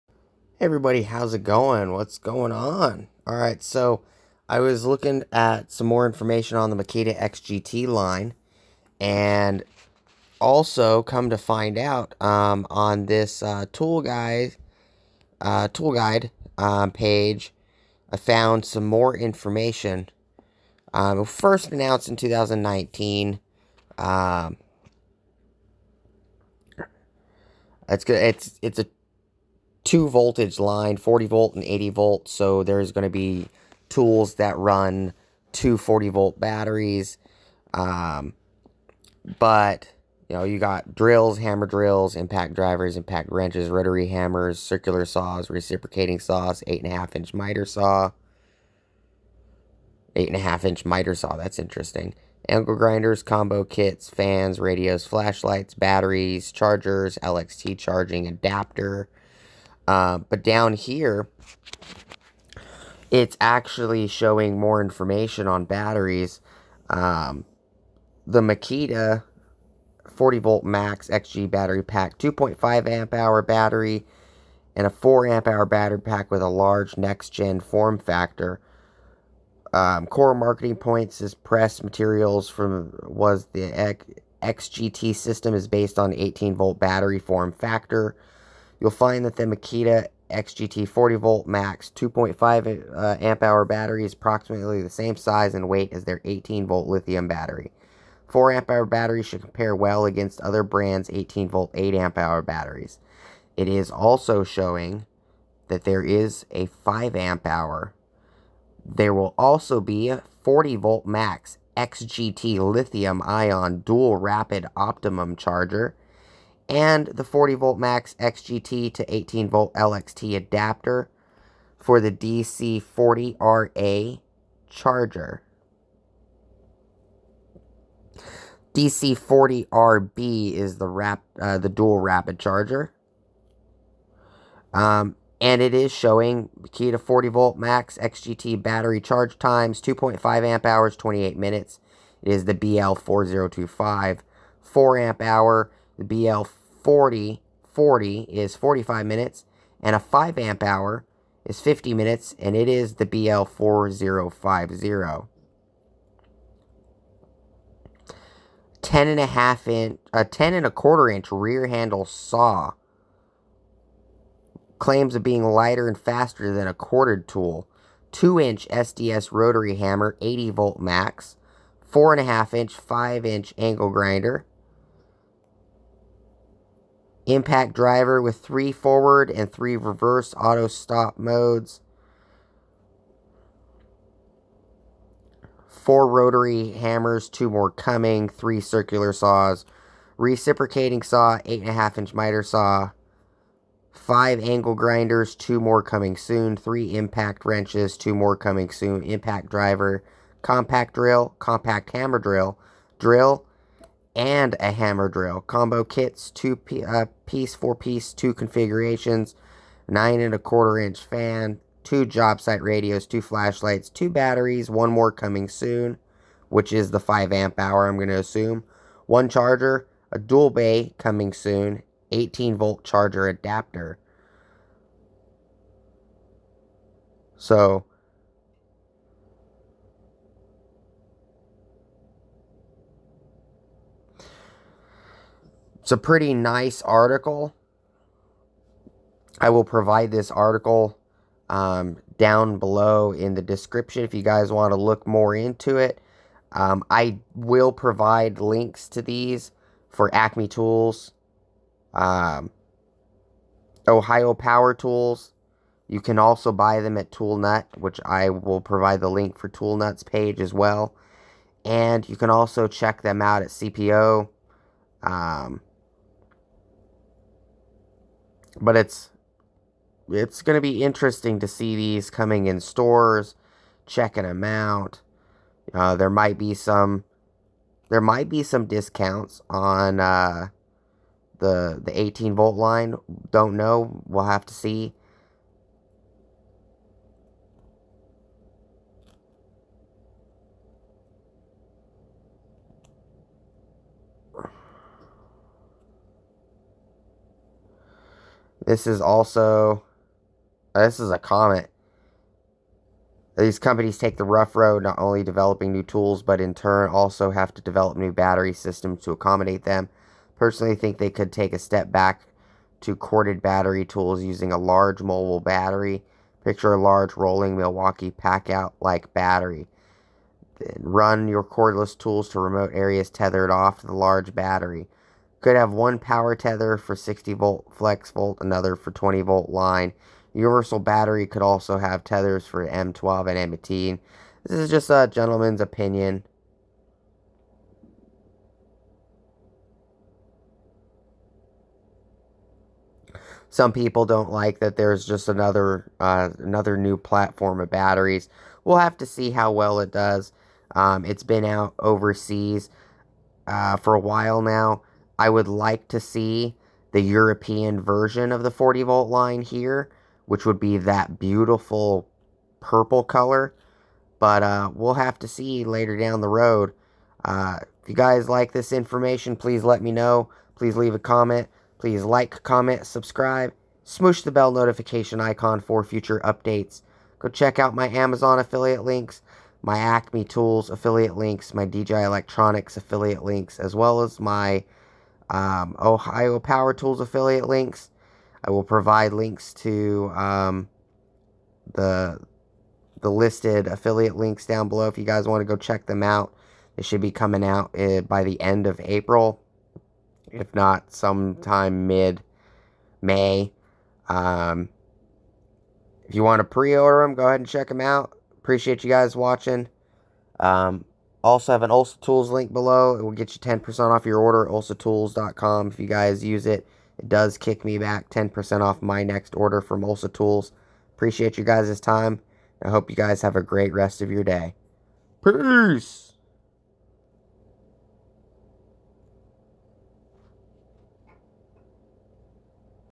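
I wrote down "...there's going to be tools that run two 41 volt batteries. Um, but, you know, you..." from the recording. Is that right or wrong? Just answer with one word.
wrong.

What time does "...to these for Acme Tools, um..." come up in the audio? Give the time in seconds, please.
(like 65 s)
248 s.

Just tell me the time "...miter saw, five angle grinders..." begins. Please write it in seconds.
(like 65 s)
192 s.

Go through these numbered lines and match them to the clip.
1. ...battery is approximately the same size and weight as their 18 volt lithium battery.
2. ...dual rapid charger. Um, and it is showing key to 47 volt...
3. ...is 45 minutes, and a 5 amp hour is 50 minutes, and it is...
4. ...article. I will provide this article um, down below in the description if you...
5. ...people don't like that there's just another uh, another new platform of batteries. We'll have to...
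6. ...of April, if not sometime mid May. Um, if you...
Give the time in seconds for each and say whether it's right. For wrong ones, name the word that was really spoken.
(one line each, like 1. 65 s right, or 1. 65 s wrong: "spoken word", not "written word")
1. 93 s right
2. 131 s wrong: "40", not "47"
3. 148 s right
4. 236 s right
5. 343 s right
6. 398 s right.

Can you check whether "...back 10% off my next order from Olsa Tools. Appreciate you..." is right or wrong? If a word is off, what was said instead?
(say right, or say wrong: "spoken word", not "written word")
right.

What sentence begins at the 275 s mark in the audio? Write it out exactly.
Uh, there might be some there might be some discounts on uh, the the 18 volt line.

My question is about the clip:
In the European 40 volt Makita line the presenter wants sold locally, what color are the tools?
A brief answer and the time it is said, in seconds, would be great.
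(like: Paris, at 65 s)
Purple, at 362 s.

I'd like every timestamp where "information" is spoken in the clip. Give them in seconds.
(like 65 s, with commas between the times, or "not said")
6 s, 19 s, 64 s, 368 s.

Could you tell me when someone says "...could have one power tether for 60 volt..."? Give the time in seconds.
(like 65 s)
325 s.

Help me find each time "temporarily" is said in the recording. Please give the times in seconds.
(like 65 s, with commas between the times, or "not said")
not said.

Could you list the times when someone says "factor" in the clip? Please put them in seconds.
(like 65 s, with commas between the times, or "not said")
77 s, 87 s.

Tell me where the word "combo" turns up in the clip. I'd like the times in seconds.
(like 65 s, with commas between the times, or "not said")
53 s, 205 s.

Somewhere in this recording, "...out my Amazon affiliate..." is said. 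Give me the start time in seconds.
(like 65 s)
377 s.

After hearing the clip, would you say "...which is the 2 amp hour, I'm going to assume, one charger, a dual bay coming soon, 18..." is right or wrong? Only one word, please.
wrong.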